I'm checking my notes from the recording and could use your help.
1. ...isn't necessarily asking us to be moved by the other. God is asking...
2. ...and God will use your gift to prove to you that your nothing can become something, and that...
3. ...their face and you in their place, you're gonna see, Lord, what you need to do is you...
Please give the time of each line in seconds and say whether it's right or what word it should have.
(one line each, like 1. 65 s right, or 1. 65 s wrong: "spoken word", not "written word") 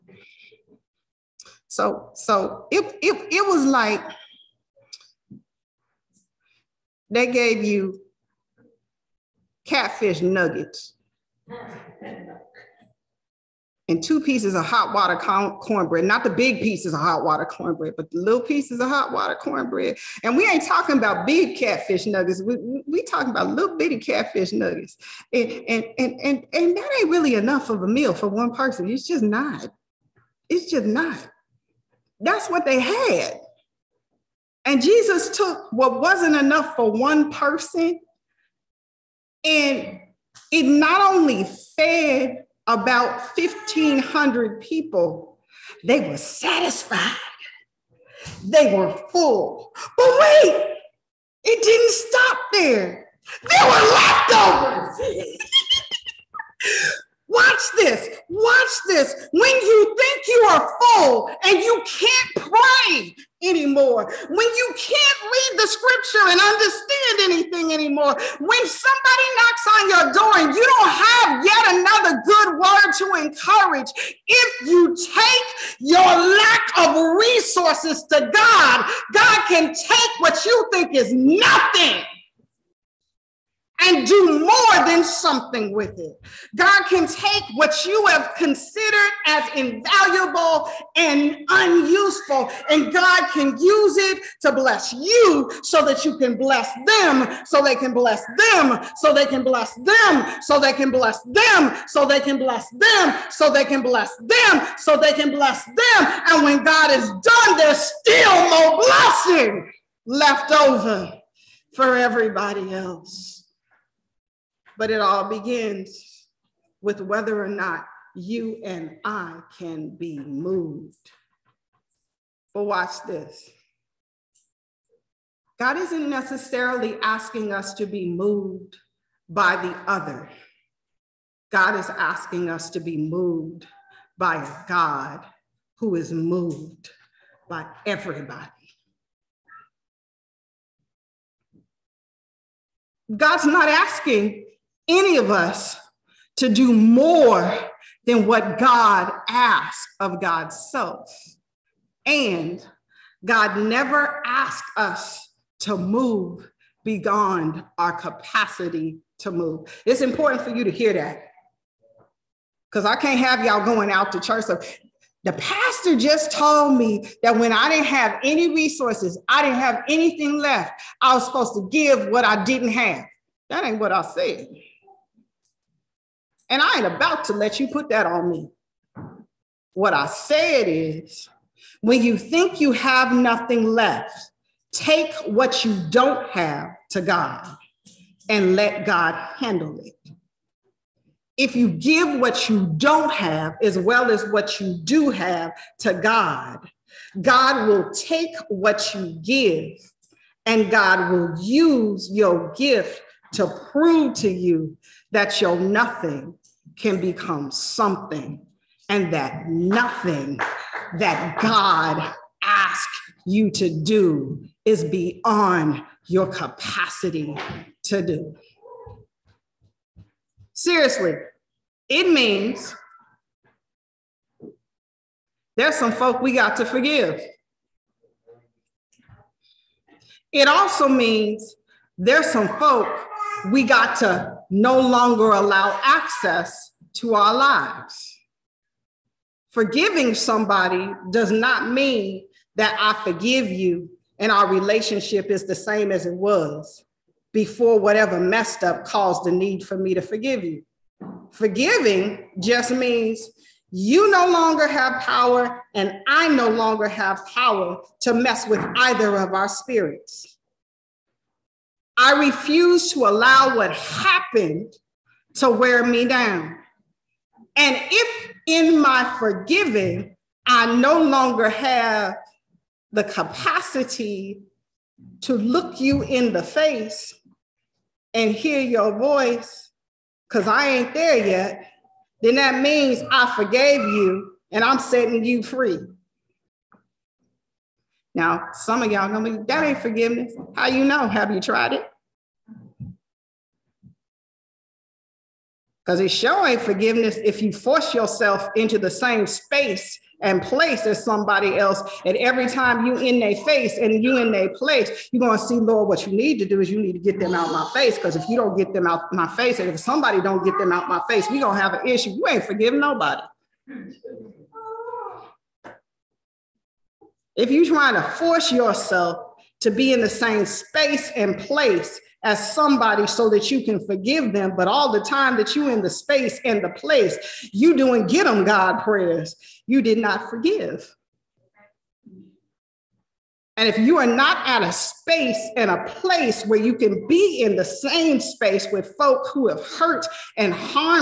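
1. 125 s right
2. 200 s right
3. 303 s right.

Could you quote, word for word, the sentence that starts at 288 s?
Now, some of y'all gonna be, that ain't forgiveness.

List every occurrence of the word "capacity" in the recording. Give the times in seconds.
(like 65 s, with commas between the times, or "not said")
157 s, 216 s, 273 s.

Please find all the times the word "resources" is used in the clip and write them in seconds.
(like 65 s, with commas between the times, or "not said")
77 s, 168 s.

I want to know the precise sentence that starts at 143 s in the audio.
God's not asking any of us to do more than what God asks of God's self.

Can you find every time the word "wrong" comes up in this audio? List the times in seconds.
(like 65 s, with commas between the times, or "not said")
not said.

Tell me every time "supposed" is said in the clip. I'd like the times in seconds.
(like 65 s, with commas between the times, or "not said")
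171 s.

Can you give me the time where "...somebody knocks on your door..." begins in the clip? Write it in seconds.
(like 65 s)
68 s.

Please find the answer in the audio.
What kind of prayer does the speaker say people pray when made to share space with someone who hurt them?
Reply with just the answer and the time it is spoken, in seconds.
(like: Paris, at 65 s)
get them God prayers, at 328 s.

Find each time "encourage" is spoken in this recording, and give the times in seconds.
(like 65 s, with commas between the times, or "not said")
73 s.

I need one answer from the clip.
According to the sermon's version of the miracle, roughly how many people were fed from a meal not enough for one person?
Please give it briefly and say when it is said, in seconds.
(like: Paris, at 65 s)
1,500, at 43 s.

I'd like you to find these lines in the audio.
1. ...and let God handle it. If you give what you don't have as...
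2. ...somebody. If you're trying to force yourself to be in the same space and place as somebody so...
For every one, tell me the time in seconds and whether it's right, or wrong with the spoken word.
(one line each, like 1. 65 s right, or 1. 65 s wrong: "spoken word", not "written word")
1. 188 s right
2. 312 s wrong: "nobody", not "somebody".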